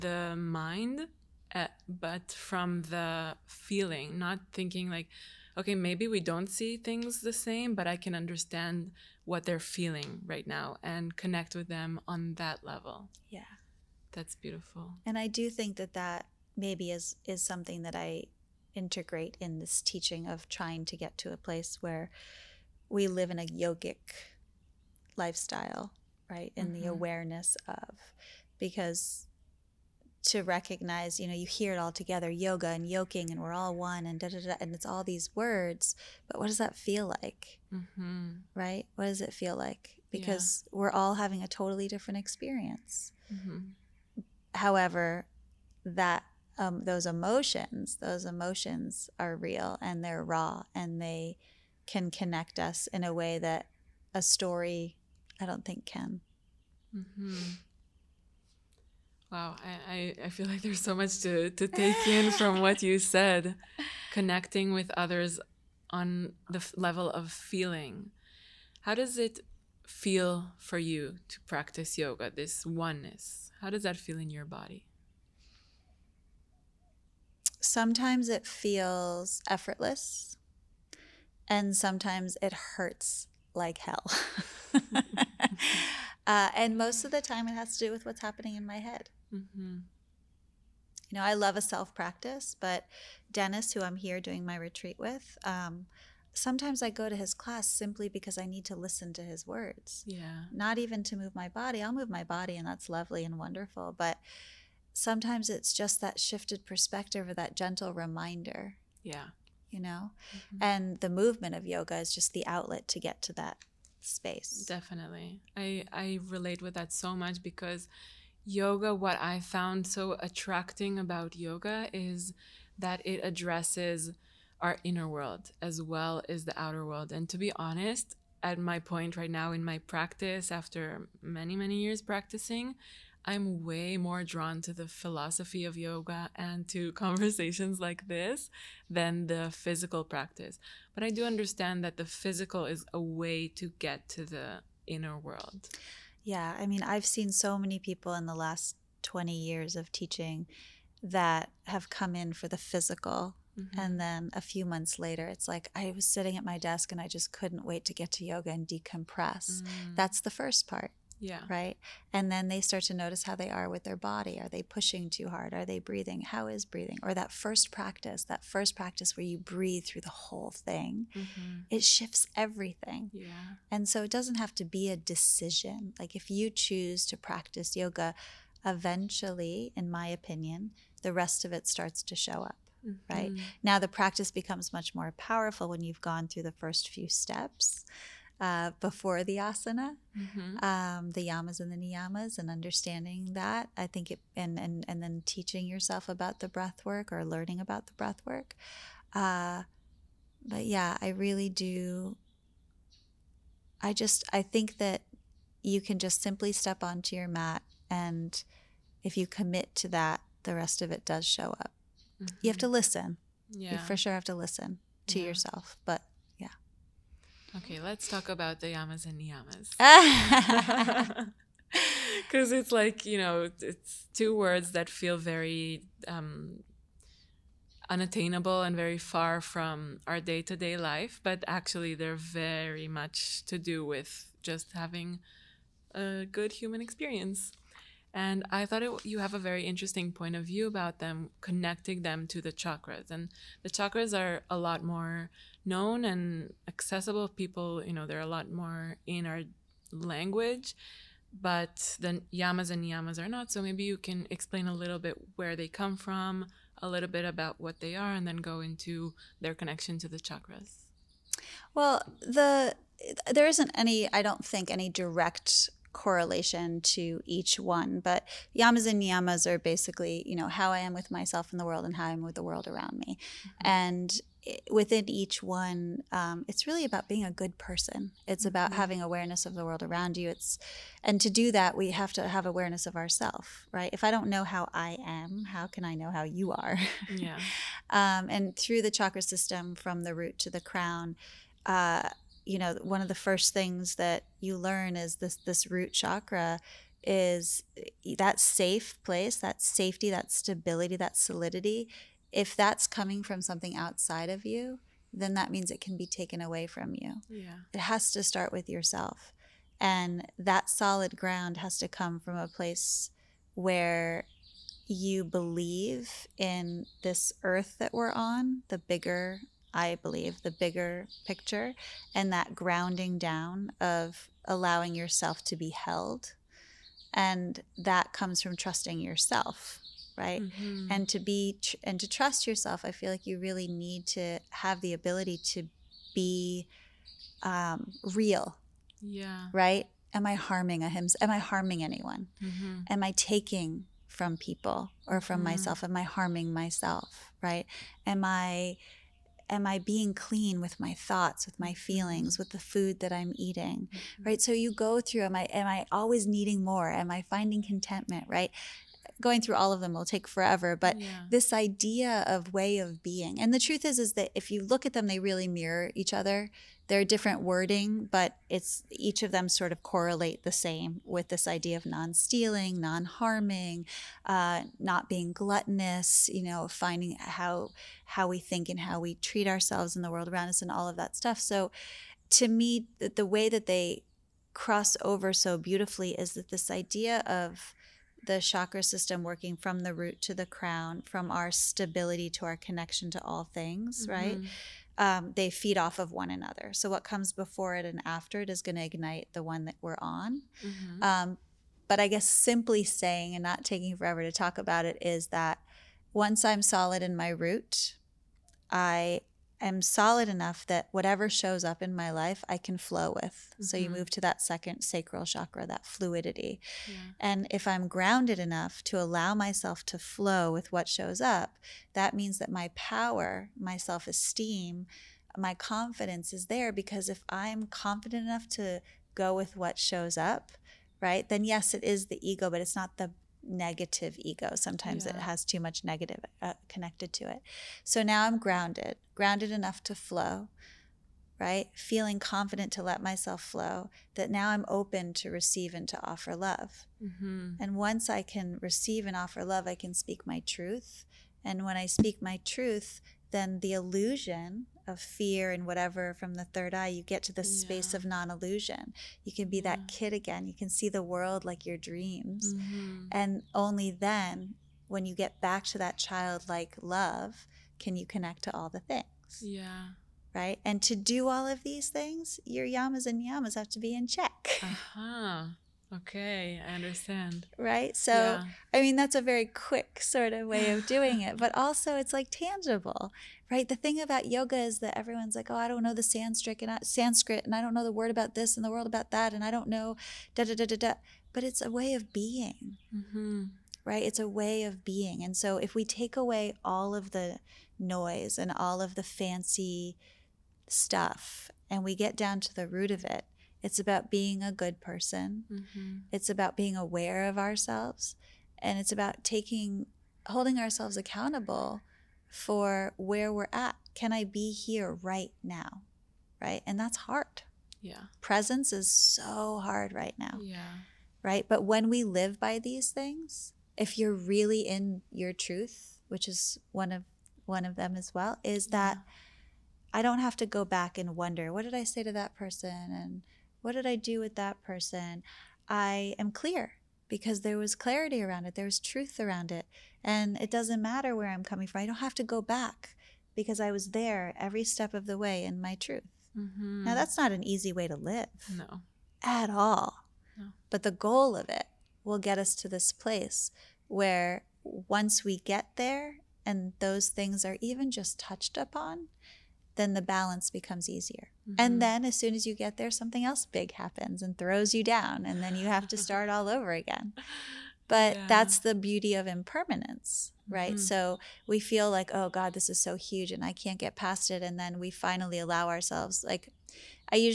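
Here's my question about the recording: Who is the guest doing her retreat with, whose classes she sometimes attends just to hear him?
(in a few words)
Dennis.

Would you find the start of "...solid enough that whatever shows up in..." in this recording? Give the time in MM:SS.
06:49.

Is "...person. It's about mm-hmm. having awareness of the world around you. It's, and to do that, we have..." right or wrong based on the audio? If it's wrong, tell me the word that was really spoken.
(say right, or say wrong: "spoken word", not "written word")
right.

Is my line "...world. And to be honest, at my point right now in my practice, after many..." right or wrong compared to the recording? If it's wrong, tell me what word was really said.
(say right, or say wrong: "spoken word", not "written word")
right.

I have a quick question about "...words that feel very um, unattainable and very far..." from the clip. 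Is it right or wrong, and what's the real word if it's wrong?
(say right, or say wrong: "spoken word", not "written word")
right.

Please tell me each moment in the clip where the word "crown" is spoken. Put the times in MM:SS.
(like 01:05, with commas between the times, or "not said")
04:50, 06:30.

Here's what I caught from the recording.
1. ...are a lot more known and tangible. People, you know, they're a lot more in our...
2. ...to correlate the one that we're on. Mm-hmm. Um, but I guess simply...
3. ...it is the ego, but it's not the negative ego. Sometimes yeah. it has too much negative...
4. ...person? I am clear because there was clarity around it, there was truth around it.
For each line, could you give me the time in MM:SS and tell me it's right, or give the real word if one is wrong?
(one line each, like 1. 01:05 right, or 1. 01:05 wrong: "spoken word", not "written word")
1. 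04:04 wrong: "accessible", not "tangible"
2. 06:38 wrong: "ignite", not "correlate"
3. 07:11 right
4. 08:54 right.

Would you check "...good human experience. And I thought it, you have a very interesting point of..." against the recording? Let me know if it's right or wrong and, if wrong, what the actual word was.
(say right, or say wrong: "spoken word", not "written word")
right.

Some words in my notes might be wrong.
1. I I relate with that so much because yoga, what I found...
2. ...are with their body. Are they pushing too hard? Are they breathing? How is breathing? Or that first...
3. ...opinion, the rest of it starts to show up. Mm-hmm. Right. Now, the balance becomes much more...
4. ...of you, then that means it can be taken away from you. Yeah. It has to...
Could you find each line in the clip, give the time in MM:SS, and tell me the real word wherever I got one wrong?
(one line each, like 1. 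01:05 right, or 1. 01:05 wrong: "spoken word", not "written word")
1. 01:55 right
2. 02:43 right
3. 03:00 wrong: "practice", not "balance"
4. 05:04 right.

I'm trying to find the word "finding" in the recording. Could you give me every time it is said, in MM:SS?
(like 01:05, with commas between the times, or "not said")
05:57, 06:16.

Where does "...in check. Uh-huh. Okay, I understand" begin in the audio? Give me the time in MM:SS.
07:53.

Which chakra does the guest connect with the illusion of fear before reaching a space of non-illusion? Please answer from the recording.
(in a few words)
third eye.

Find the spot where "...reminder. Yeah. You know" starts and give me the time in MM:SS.
01:47.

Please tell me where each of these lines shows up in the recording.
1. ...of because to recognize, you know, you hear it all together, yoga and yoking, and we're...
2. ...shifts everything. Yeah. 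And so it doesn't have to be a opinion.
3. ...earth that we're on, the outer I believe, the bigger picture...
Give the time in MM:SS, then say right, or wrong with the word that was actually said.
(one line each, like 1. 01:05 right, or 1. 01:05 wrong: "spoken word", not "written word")
1. 00:27 right
2. 02:51 wrong: "decision", not "opinion"
3. 05:17 wrong: "bigger", not "outer".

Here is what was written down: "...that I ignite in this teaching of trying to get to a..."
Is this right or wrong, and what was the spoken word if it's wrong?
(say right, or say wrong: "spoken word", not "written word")
wrong: "integrate", not "ignite".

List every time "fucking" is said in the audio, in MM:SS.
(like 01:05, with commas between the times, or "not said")
not said.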